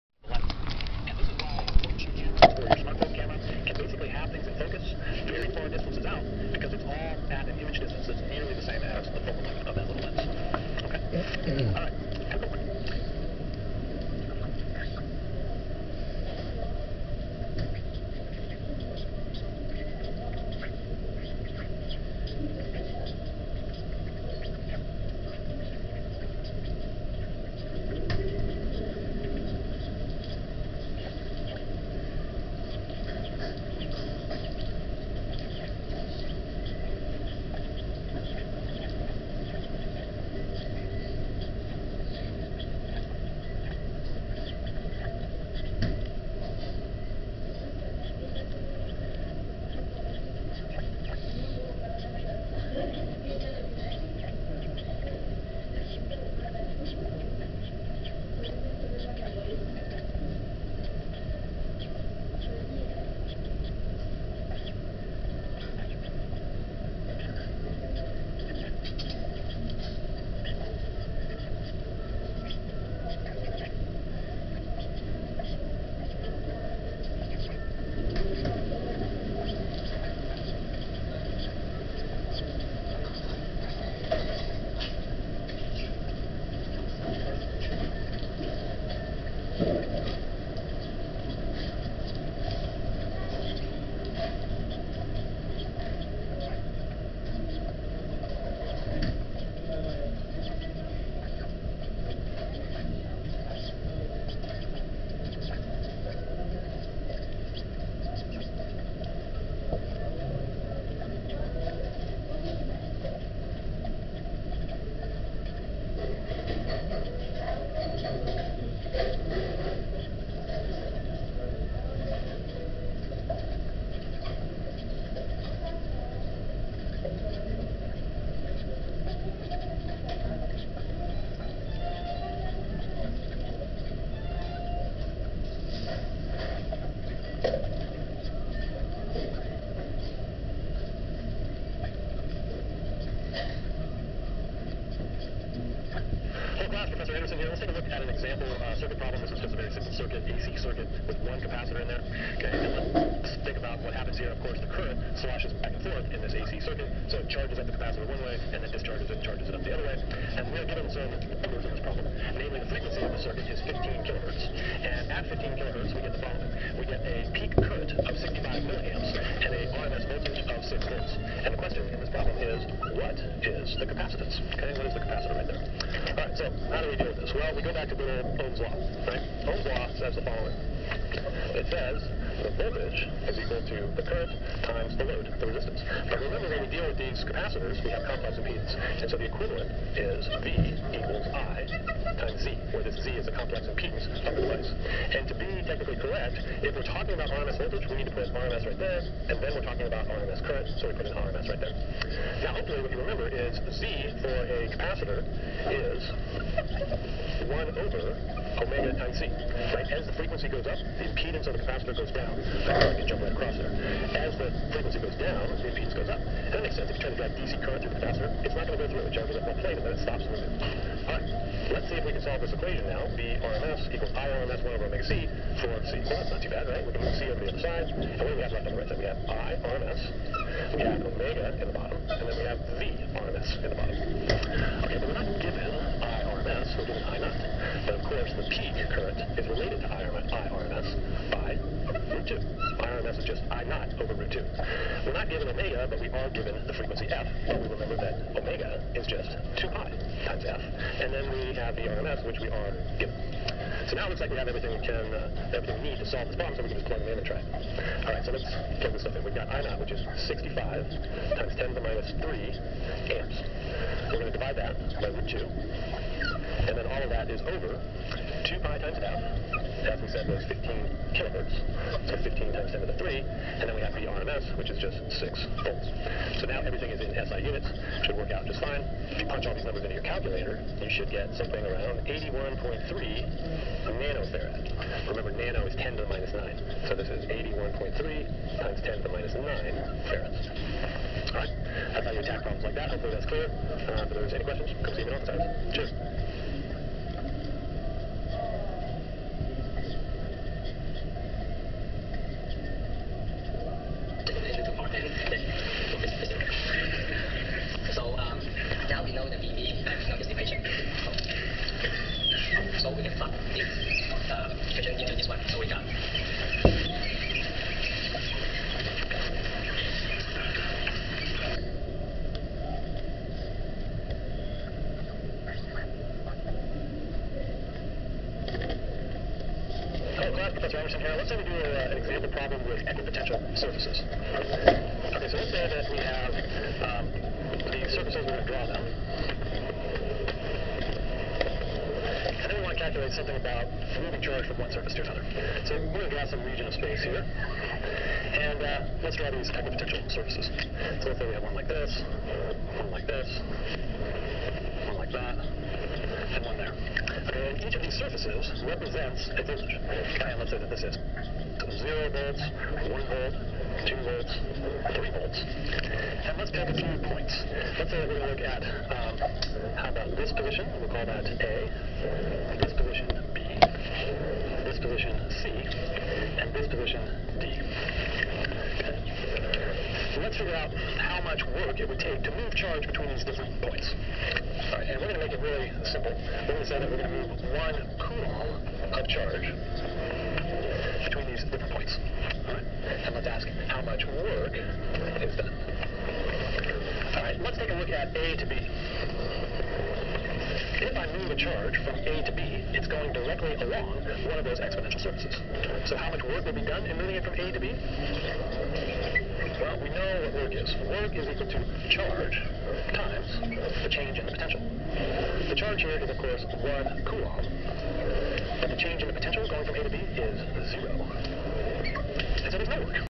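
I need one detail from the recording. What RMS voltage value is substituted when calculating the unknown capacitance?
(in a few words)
6 volts.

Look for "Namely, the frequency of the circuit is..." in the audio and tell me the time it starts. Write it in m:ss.
2:42.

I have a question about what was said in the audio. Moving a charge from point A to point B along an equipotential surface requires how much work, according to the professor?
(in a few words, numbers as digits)
0.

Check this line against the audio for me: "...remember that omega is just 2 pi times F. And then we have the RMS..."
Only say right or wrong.
right.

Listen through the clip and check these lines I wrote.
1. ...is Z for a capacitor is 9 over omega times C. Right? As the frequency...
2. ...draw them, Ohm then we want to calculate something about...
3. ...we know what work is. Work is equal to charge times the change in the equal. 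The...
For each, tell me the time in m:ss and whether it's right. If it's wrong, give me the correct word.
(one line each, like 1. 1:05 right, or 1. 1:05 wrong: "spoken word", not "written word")
1. 3:23 wrong: "1", not "9"
2. 5:38 wrong: "And", not "Ohm"
3. 6:49 wrong: "potential", not "equal".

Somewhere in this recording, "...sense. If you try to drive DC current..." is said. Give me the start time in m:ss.
3:36.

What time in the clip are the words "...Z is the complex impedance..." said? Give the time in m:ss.
3:13.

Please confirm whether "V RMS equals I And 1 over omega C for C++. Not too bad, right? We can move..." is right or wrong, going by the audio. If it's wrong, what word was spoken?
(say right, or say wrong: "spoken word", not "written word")
wrong: "RMS", not "And".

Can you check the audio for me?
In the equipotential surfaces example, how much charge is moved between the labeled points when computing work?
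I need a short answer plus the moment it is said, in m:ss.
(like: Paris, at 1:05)
1 coulomb, at 6:27.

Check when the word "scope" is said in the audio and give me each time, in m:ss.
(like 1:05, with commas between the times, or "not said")
not said.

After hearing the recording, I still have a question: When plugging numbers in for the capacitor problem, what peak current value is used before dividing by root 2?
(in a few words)
65 × 10^-3 amps.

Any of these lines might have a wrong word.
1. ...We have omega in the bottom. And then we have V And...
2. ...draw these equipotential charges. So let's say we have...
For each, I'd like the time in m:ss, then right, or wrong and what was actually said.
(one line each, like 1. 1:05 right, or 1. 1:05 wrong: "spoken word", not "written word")
1. 3:50 wrong: "RMS", not "And"
2. 5:49 wrong: "surfaces", not "charges".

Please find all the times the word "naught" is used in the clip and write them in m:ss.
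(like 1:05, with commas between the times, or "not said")
3:57, 4:03, 4:19.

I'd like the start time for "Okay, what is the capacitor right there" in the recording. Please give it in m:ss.
2:54.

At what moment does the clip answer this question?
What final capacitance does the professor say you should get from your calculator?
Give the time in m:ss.
4:42.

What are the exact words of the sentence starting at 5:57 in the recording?
And each of these surfaces represents a voltage.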